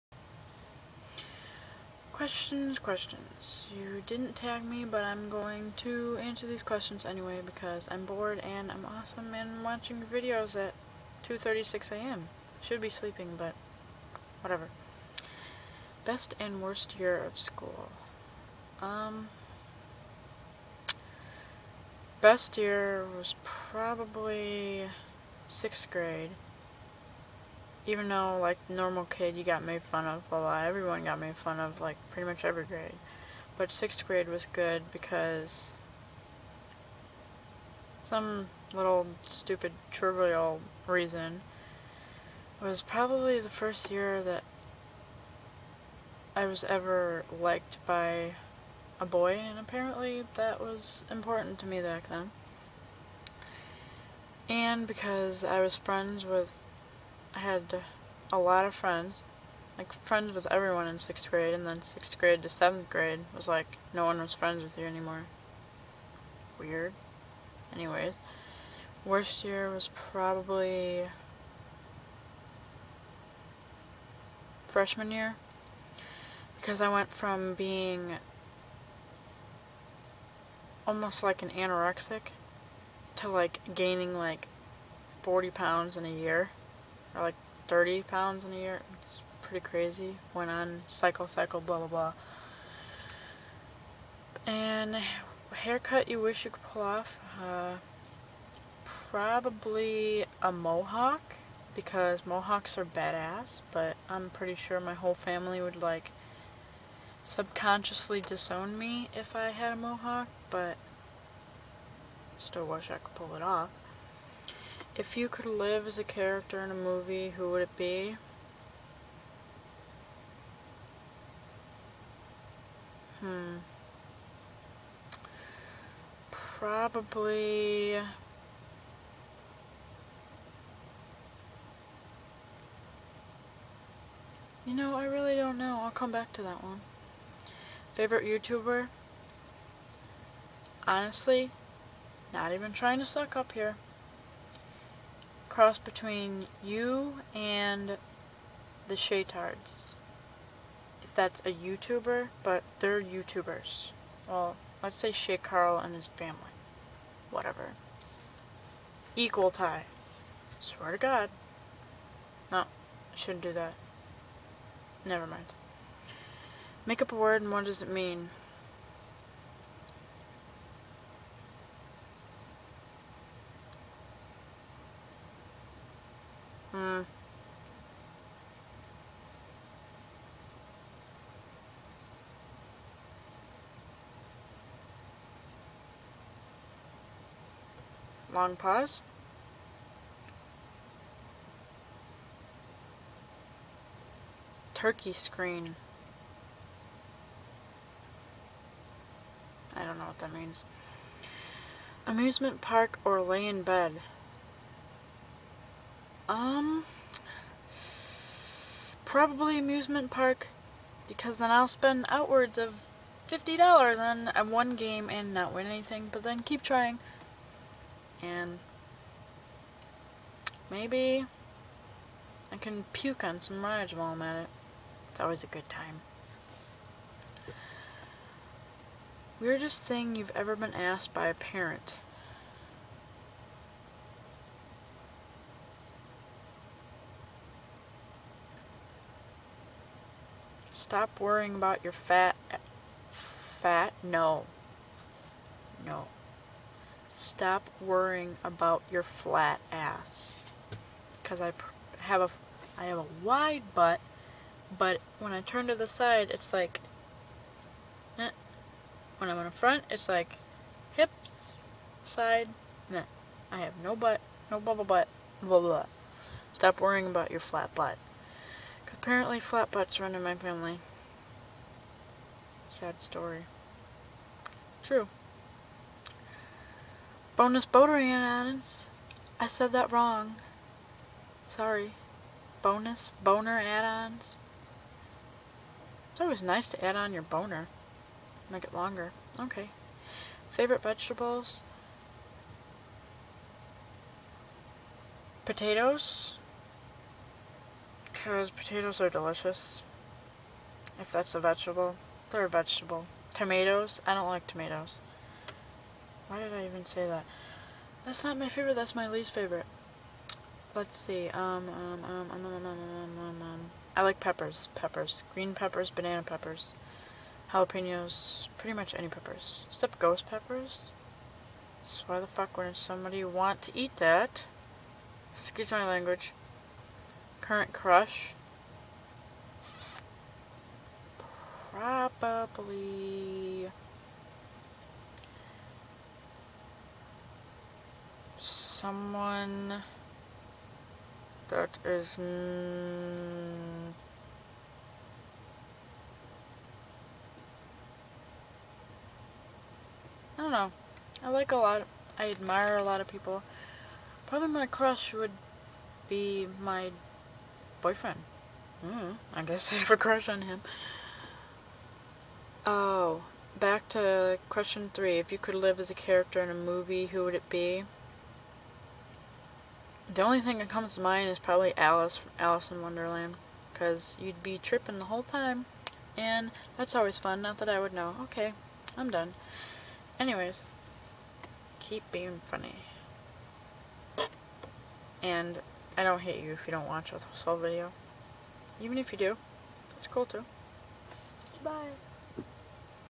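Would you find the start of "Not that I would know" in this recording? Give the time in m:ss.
6:17.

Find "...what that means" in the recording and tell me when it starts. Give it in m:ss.
3:20.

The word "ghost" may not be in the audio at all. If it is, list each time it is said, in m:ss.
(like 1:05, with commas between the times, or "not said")
5:19.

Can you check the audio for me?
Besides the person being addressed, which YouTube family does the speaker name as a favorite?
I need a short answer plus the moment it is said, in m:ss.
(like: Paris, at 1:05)
The Shaytards, at 2:28.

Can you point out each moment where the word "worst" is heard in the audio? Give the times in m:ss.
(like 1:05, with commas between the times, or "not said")
0:16, 1:09.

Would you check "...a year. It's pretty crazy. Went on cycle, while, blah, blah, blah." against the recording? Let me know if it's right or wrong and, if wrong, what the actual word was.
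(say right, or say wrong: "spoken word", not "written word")
wrong: "cycle", not "while".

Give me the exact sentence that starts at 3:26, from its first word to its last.
Um, probably amusement park because then I'll spend outwards of $50 on, one game and not win anything, but then keep trying.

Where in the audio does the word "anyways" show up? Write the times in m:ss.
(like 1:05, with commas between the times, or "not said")
0:07, 1:07, 6:20.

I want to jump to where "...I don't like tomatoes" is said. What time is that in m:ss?
5:04.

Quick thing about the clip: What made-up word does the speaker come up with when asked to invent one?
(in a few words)
Turkey screen.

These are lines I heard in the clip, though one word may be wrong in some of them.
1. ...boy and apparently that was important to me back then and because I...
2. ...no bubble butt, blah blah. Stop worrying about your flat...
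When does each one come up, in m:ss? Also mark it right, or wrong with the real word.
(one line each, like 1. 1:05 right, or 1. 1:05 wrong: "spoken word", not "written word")
1. 0:49 right
2. 4:24 right.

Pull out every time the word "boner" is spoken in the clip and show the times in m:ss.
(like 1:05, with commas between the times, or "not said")
4:43, 4:47.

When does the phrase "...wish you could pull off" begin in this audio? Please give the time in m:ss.
1:36.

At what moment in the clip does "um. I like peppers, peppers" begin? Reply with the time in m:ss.
5:13.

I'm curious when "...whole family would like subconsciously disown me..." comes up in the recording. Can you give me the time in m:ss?
1:44.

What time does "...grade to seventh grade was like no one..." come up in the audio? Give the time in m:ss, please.
1:02.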